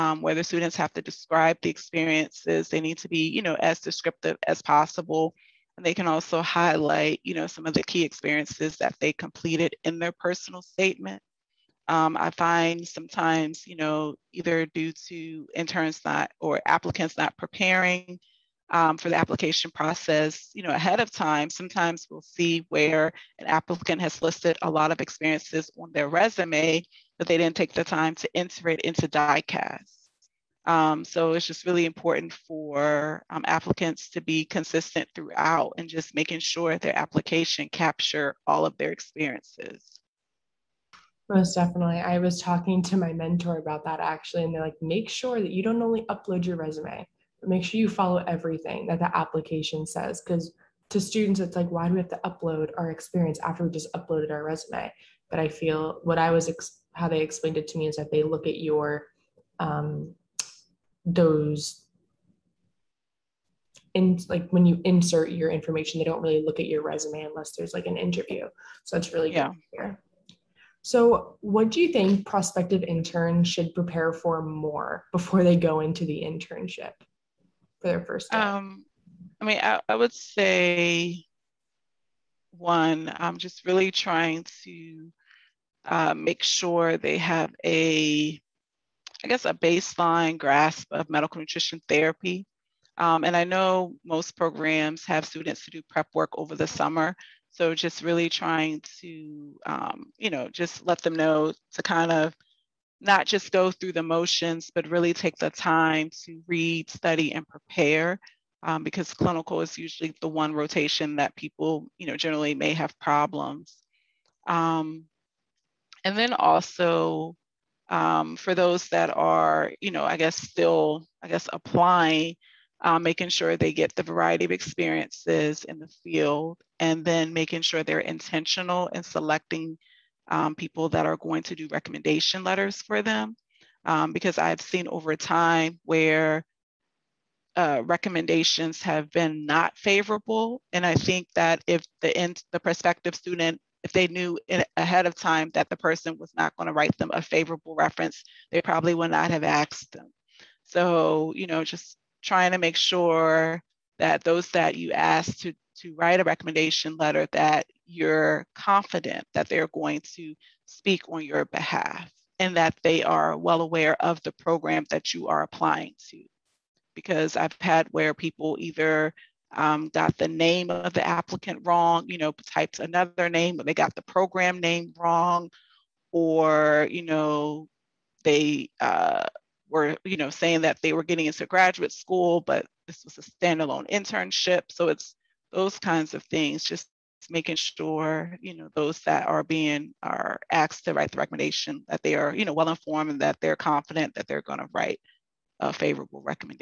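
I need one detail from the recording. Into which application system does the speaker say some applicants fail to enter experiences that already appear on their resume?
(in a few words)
DICAS.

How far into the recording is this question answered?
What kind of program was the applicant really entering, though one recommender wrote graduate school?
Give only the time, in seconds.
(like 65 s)
183 s.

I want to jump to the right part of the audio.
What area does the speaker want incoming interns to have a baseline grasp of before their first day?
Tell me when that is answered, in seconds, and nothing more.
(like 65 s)
91 s.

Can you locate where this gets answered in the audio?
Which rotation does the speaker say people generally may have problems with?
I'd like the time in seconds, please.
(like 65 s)
109 s.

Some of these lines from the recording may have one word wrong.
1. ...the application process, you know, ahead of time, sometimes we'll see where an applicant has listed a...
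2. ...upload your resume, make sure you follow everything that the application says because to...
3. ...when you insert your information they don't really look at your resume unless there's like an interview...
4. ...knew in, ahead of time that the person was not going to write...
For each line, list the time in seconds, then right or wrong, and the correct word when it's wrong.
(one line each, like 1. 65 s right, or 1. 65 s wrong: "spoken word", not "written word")
1. 19 s right
2. 46 s right
3. 64 s right
4. 144 s right.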